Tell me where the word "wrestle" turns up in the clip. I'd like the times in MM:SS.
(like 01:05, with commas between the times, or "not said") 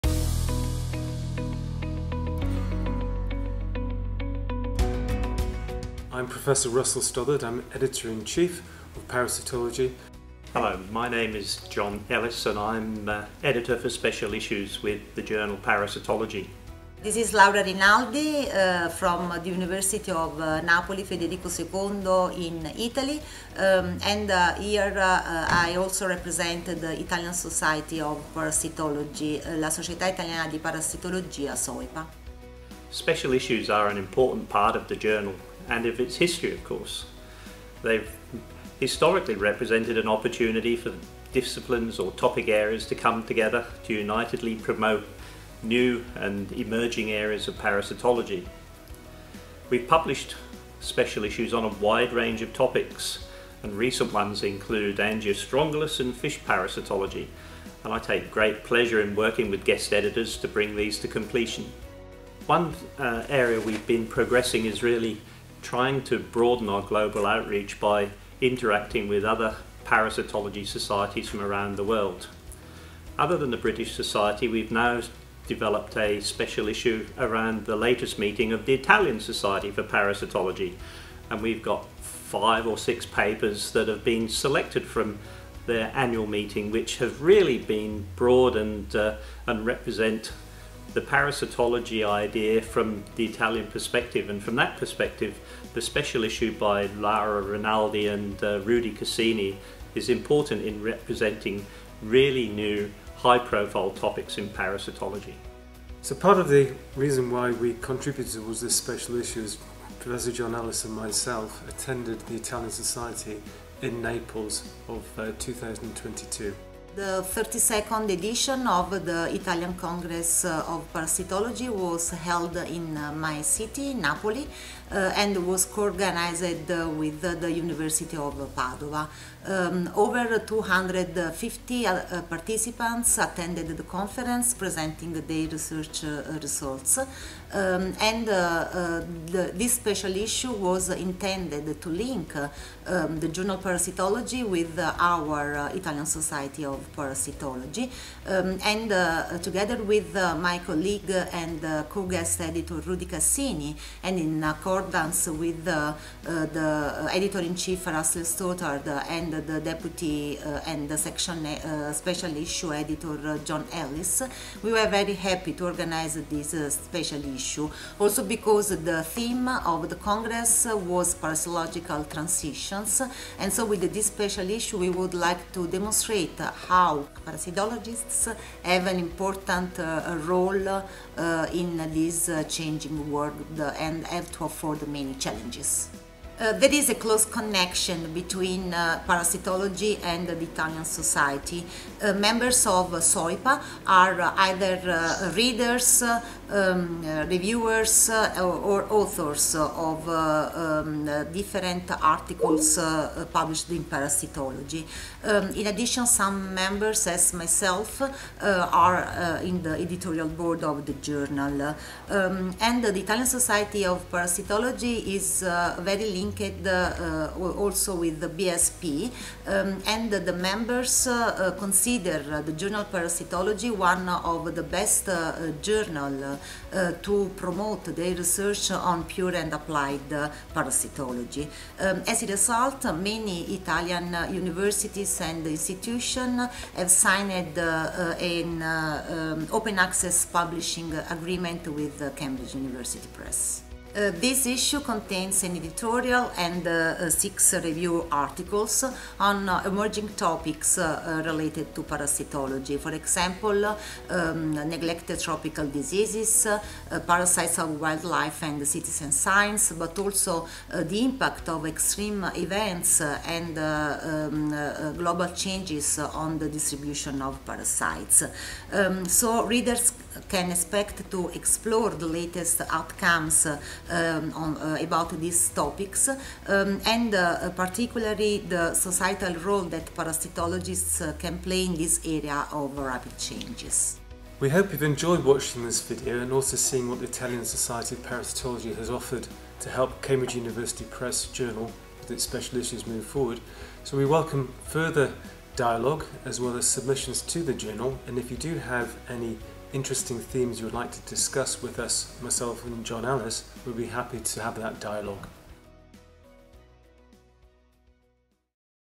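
not said.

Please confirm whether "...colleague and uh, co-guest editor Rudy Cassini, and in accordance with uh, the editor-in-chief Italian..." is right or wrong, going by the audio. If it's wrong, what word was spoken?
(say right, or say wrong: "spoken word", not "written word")
wrong: "Russell", not "Italian".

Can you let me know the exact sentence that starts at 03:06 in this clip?
Uh, there is a close connection between uh, parasitology and uh, the Italian society.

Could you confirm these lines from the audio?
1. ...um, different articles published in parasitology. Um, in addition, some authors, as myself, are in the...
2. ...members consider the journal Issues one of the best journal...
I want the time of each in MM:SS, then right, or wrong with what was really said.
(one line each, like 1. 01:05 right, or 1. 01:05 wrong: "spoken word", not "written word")
1. 03:20 wrong: "members", not "authors"
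2. 03:40 wrong: "Parasitology", not "Issues".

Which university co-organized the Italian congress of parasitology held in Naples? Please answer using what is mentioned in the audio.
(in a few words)
University of Padua.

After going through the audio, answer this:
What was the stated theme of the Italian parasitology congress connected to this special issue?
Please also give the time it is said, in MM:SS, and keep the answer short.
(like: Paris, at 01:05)
Parasitological transition, at 02:51.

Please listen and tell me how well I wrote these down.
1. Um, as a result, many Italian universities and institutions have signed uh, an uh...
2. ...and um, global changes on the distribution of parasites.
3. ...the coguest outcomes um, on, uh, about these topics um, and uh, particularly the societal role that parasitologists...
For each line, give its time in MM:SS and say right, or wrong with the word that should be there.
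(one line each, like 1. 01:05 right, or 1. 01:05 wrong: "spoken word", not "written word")
1. 03:51 right
2. 04:23 right
3. 04:31 wrong: "latest", not "coguest".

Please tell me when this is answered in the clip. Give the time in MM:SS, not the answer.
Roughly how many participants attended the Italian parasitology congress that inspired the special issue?
02:09.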